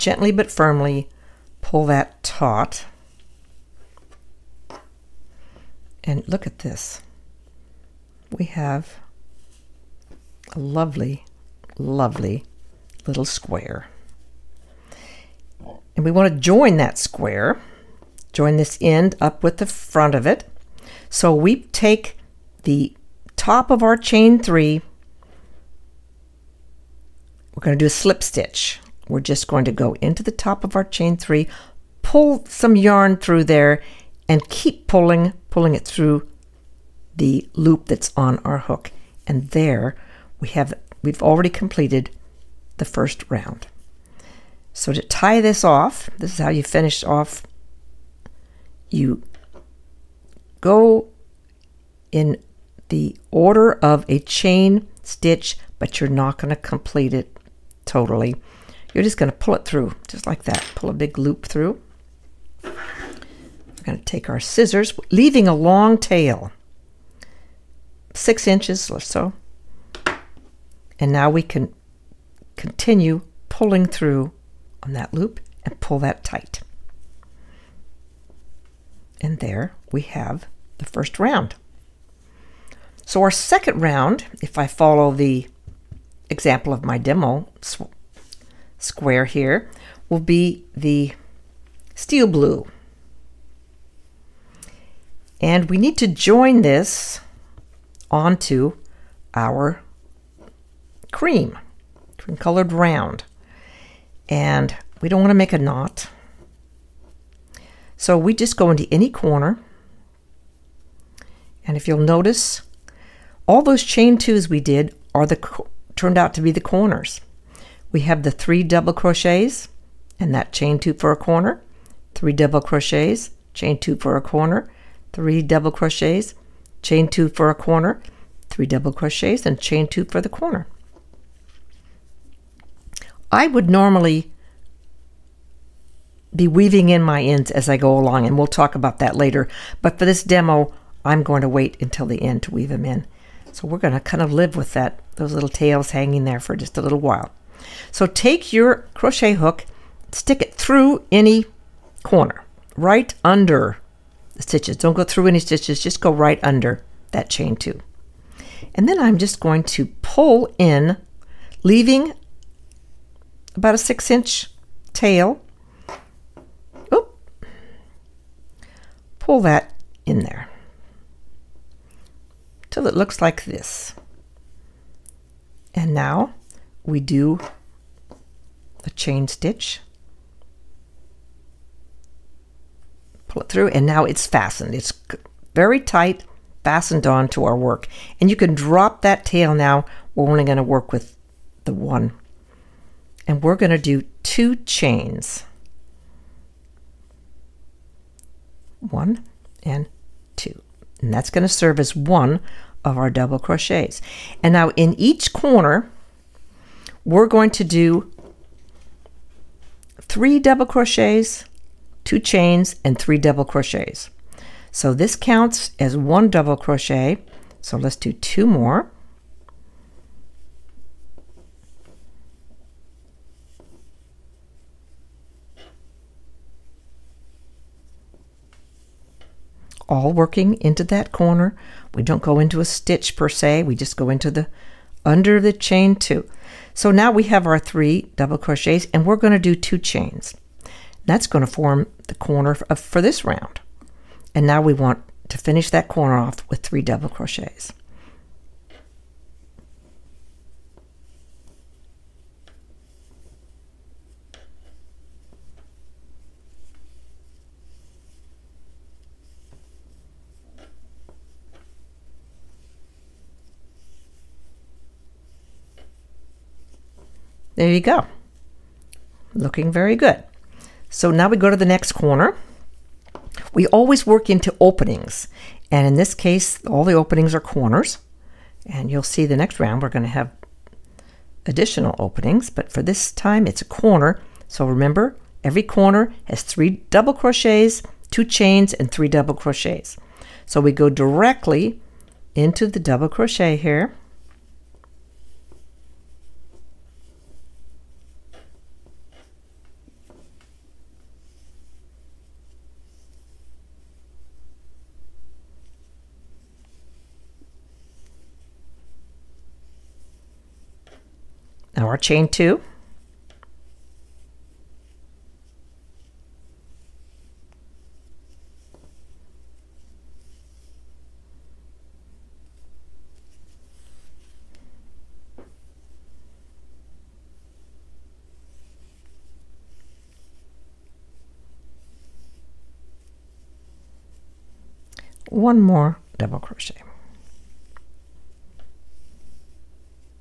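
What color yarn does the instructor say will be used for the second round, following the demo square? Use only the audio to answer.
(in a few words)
steel blue.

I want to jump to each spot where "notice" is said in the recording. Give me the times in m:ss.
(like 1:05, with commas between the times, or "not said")
1:51.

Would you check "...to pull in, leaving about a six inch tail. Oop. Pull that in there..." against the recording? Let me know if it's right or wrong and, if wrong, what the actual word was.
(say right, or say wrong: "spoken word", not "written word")
right.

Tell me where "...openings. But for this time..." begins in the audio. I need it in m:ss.
4:41.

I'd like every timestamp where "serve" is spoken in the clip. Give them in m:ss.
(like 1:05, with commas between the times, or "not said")
3:21.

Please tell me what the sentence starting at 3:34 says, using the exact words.
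So this counts as one double crochet.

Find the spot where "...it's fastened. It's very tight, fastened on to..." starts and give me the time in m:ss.
3:04.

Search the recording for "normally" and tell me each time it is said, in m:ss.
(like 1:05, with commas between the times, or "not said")
2:13.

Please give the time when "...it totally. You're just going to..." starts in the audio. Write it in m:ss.
0:57.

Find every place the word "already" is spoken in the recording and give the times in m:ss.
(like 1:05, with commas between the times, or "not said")
0:41.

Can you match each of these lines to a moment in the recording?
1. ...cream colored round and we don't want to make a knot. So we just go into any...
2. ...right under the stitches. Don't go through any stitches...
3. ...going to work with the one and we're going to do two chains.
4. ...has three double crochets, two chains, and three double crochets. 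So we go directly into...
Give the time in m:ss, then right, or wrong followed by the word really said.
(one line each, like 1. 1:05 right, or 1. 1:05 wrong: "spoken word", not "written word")
1. 1:42 right
2. 2:32 right
3. 3:10 right
4. 4:46 right.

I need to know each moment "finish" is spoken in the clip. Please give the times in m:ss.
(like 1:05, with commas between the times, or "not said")
0:46, 4:05.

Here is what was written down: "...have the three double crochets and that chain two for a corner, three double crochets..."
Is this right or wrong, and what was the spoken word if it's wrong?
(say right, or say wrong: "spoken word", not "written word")
right.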